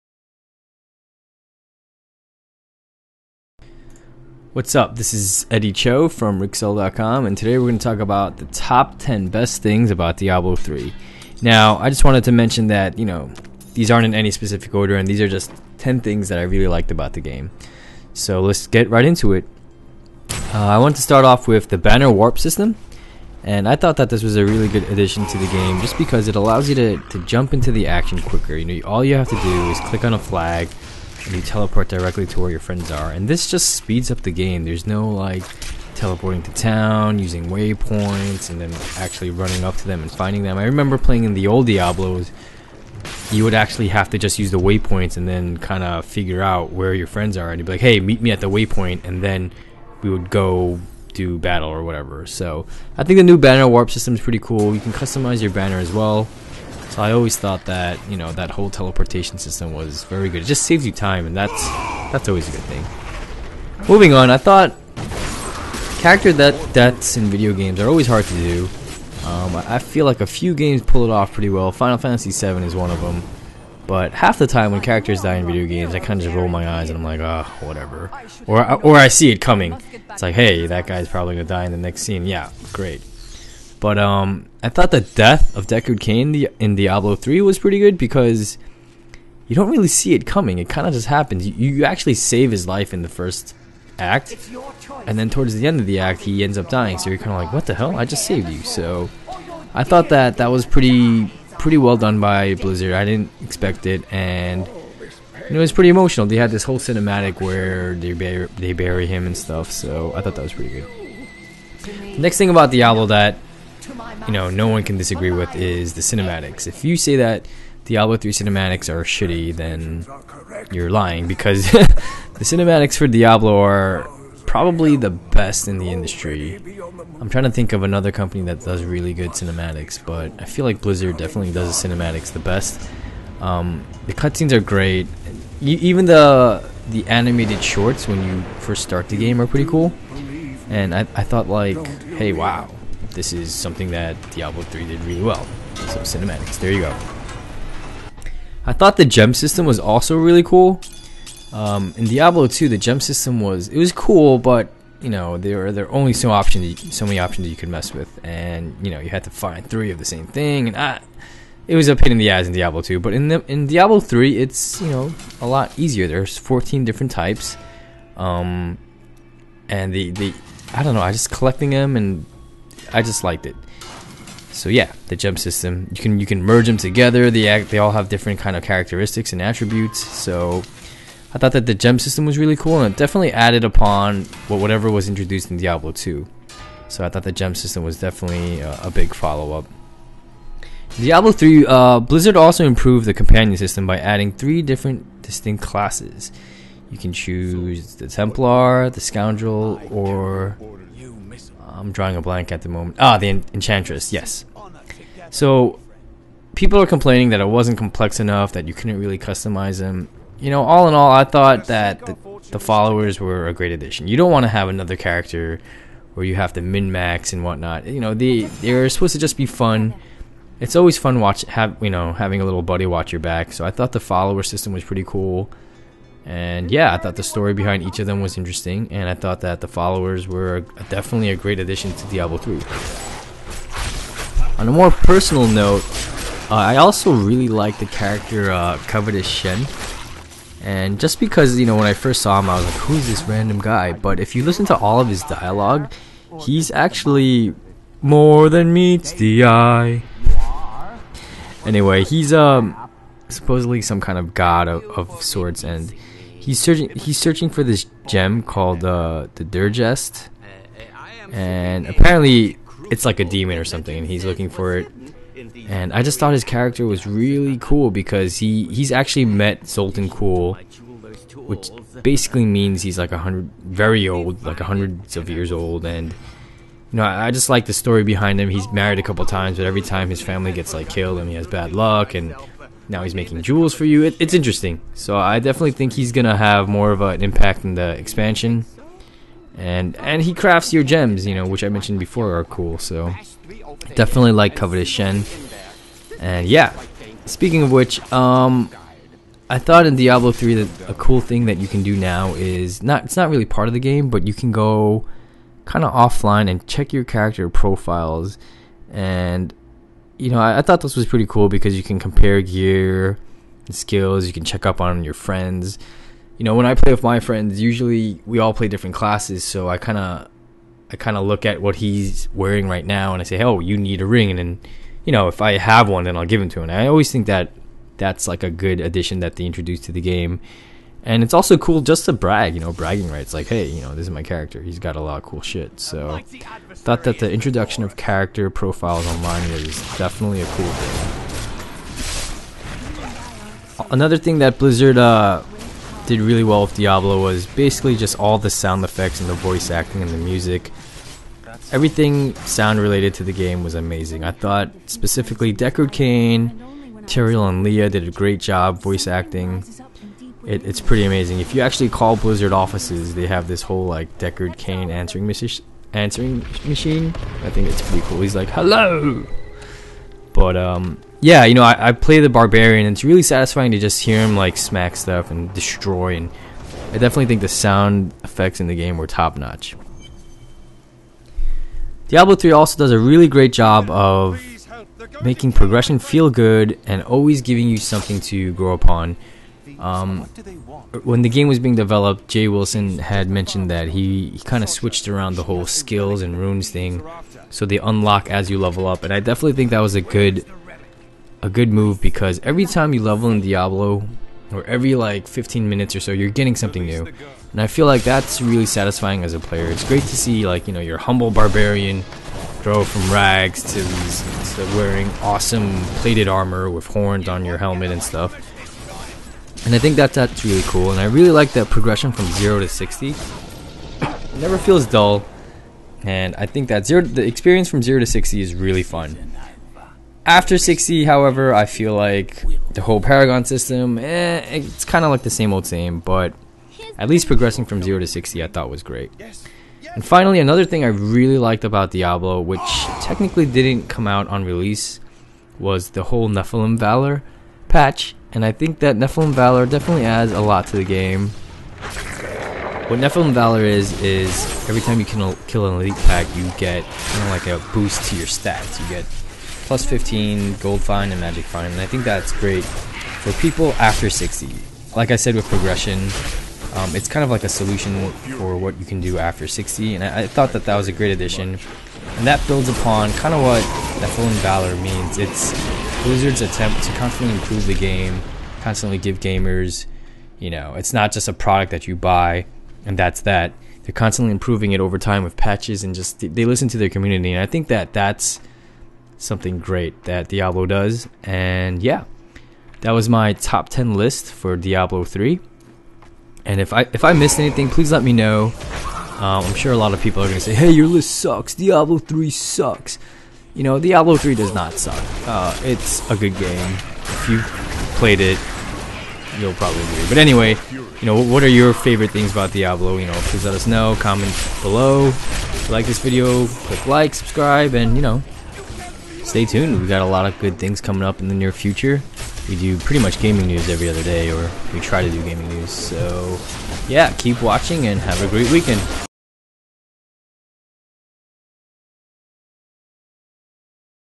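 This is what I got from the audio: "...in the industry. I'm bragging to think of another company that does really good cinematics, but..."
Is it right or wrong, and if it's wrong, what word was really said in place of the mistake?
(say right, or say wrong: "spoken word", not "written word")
wrong: "trying", not "bragging".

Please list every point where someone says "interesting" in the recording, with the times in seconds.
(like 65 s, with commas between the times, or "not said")
228 s, 284 s.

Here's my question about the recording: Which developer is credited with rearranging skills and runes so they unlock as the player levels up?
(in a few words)
Jay Wilson.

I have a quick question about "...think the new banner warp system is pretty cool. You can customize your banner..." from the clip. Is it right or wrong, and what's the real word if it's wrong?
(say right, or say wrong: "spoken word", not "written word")
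right.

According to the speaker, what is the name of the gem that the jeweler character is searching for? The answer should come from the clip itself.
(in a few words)
the Dirgest.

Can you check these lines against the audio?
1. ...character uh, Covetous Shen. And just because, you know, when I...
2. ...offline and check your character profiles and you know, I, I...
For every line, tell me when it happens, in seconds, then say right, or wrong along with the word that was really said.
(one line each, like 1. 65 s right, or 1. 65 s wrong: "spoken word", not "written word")
1. 237 s right
2. 305 s right.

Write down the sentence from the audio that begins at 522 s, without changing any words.
We do pretty much gaming news every other day, or we try to do gaming news.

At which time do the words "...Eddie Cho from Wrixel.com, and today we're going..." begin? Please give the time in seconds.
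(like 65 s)
5 s.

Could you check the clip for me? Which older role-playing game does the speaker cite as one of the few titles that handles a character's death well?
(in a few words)
Final Fantasy VII.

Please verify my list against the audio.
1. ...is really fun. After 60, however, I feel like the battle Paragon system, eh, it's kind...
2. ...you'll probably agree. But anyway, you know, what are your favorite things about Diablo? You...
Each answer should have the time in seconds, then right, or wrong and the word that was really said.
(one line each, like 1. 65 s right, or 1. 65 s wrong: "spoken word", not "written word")
1. 428 s wrong: "whole", not "battle"
2. 509 s right.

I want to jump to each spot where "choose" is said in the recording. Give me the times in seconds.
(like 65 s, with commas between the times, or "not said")
197 s.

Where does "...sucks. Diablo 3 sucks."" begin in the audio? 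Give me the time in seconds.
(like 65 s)
501 s.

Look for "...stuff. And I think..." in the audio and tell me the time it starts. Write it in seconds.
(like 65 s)
418 s.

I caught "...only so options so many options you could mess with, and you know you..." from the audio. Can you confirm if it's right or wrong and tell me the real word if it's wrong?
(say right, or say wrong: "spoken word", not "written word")
right.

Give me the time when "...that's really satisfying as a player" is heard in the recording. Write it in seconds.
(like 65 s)
408 s.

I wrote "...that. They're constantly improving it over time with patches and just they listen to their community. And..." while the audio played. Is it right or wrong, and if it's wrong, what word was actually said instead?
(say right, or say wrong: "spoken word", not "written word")
right.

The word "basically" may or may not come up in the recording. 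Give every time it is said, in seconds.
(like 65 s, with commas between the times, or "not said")
272 s, 347 s.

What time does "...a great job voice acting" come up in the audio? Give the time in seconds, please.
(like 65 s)
358 s.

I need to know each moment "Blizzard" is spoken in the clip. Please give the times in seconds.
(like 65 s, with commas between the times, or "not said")
102 s, 130 s, 192 s, 344 s, 362 s, 476 s.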